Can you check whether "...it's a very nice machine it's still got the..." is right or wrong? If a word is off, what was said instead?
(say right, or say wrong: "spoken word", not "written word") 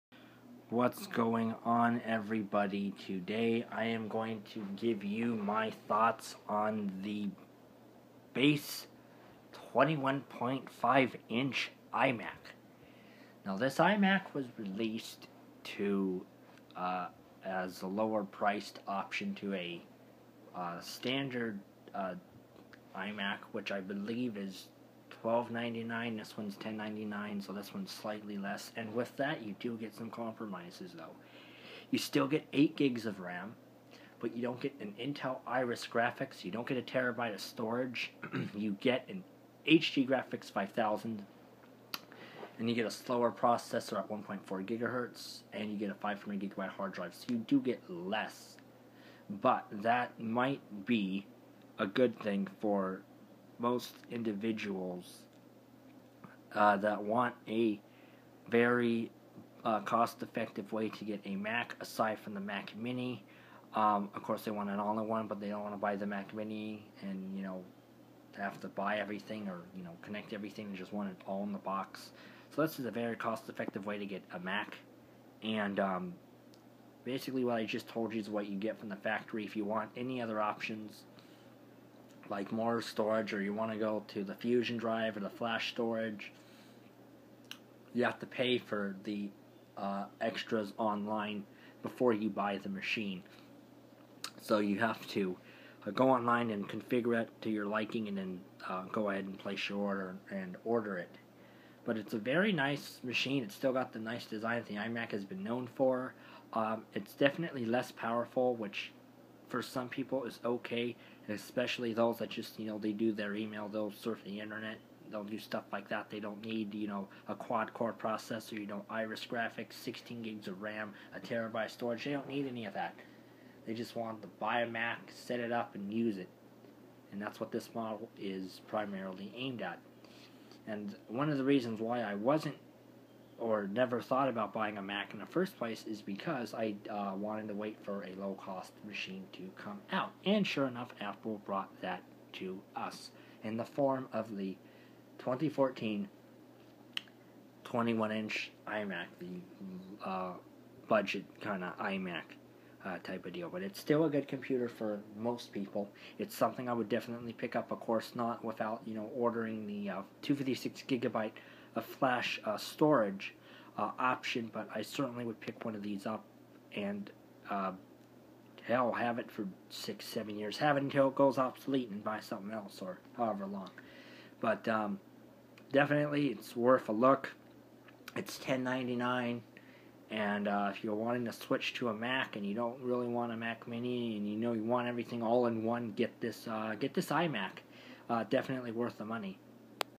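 right.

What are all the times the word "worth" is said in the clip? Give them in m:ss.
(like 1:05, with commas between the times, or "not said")
2:56, 3:08.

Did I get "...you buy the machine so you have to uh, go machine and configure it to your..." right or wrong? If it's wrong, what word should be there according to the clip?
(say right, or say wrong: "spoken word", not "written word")
wrong: "online", not "machine".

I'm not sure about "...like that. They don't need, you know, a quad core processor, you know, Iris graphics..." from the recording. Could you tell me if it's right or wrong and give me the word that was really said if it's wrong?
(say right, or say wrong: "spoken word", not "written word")
right.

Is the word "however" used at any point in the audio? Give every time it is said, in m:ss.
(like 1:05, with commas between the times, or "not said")
2:53.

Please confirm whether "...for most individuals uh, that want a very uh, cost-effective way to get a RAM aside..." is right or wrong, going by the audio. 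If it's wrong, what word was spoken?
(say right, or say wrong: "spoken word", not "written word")
wrong: "Mac", not "RAM".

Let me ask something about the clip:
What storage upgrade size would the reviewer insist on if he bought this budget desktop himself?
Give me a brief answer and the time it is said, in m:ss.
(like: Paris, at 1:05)
256 GB, at 2:40.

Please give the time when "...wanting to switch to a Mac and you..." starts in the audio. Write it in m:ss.
3:00.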